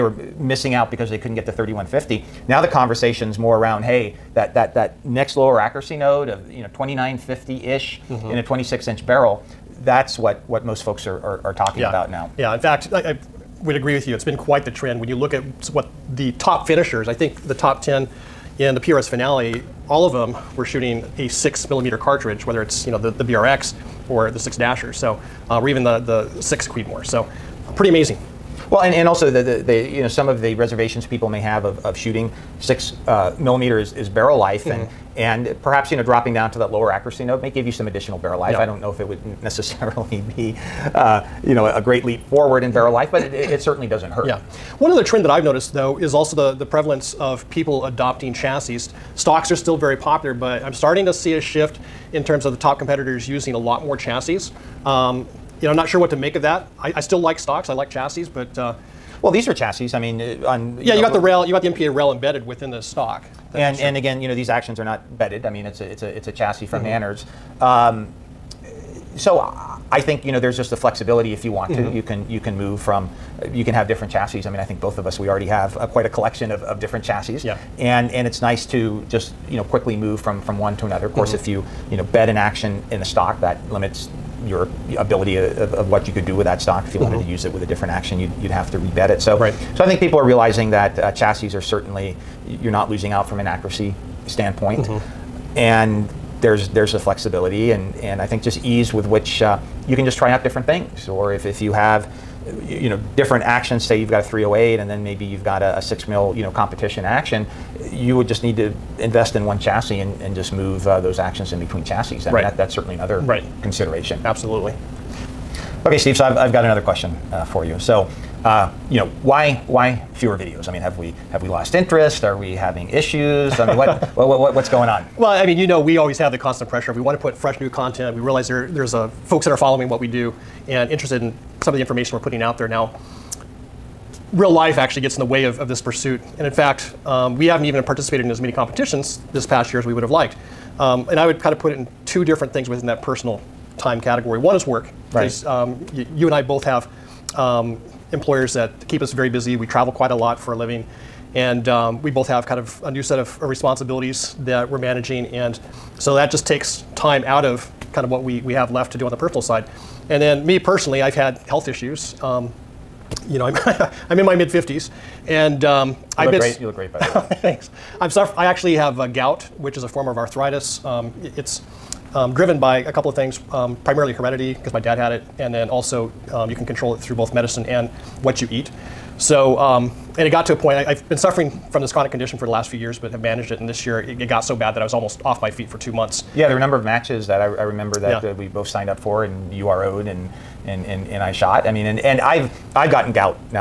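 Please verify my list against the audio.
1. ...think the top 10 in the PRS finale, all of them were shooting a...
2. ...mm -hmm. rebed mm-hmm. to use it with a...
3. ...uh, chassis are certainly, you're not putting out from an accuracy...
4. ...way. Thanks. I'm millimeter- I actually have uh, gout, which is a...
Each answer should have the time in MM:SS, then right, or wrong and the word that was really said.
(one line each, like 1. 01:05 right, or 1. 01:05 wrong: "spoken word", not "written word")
1. 00:17 right
2. 01:26 wrong: "wanted", not "rebed"
3. 01:30 wrong: "losing", not "putting"
4. 02:47 wrong: "suffer", not "millimeter".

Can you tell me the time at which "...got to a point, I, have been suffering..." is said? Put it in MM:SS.
03:00.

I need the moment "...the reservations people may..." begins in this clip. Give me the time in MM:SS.
00:30.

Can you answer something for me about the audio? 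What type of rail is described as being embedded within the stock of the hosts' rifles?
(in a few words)
MPA rail.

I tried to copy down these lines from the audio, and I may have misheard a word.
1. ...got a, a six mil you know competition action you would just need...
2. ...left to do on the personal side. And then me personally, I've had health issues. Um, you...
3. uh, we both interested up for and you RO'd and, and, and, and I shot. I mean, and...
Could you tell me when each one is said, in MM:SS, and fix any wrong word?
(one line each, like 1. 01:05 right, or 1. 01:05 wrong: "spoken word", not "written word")
1. 01:45 right
2. 02:38 right
3. 03:08 wrong: "signed", not "interested".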